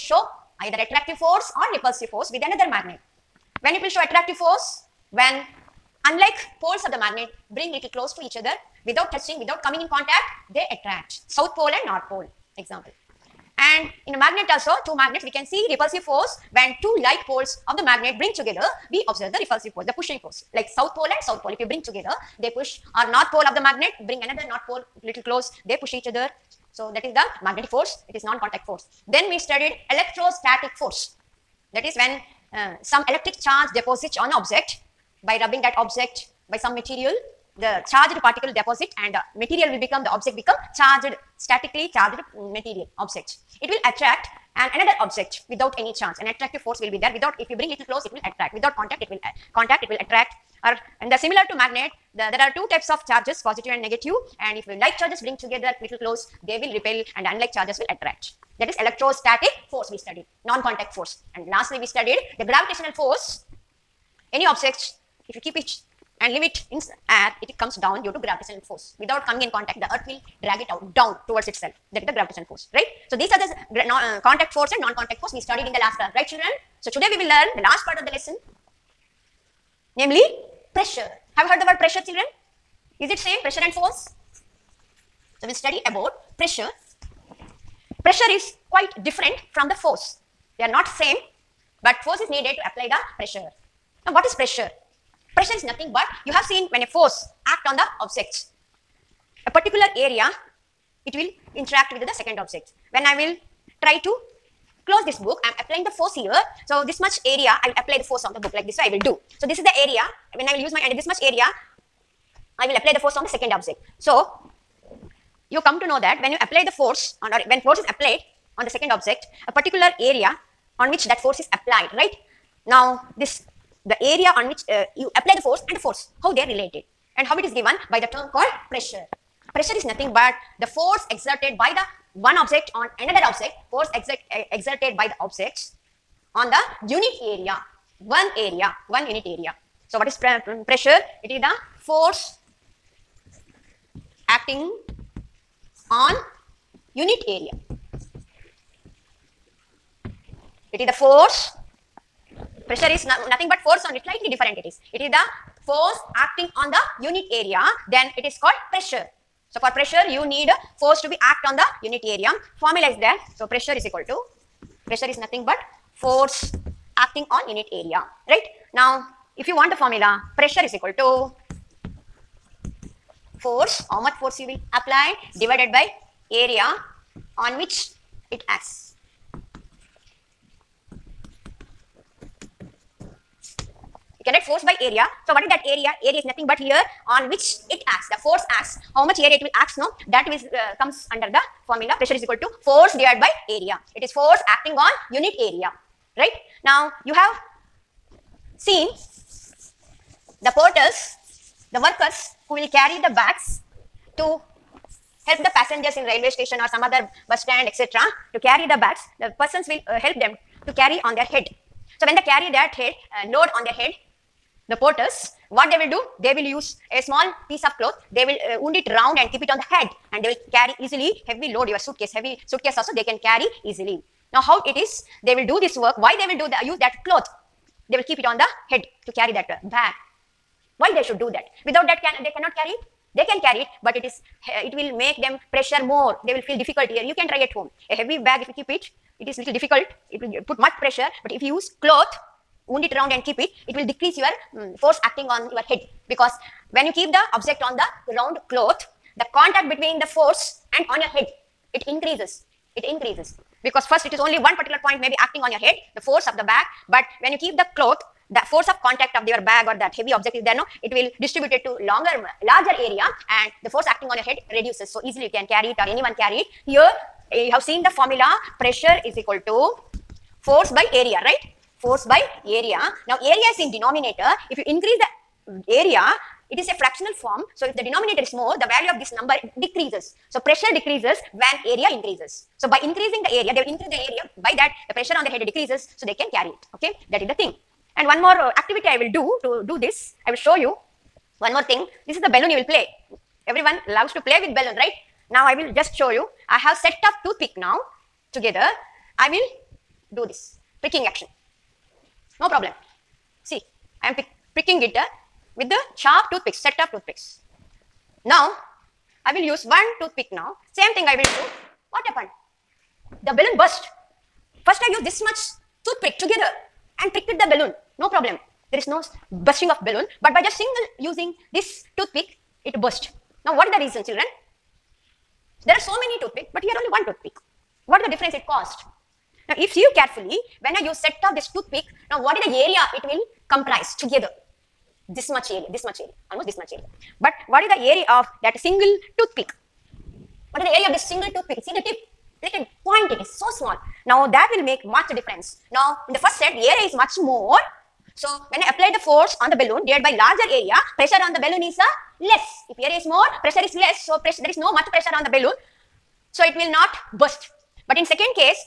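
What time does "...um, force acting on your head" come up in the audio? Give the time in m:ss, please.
4:04.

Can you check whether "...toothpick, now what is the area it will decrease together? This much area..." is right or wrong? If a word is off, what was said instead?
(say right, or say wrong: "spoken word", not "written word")
wrong: "comprise", not "decrease".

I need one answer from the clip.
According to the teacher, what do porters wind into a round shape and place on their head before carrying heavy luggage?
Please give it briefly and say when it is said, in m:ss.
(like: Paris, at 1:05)
a small piece of cloth, at 3:36.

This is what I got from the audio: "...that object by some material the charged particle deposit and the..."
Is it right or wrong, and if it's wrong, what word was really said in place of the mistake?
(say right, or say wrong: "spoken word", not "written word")
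right.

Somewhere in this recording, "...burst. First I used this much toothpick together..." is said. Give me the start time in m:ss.
5:13.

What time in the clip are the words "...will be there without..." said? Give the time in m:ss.
0:46.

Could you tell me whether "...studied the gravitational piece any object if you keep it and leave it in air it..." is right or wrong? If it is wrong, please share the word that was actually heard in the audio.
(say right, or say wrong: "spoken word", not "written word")
wrong: "force", not "piece".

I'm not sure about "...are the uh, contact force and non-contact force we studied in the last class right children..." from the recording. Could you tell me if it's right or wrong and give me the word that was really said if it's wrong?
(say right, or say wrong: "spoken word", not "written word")
right.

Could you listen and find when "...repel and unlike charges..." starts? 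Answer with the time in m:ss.
0:56.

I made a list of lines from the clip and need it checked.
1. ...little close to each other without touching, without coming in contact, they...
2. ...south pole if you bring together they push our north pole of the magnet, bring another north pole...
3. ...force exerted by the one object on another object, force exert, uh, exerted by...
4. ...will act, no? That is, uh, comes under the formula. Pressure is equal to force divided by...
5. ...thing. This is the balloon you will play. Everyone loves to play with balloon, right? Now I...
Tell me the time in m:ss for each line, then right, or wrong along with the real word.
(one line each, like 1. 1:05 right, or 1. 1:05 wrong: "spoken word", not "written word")
1. 0:07 right
2. 0:21 right
3. 2:10 right
4. 3:09 right
5. 4:51 right.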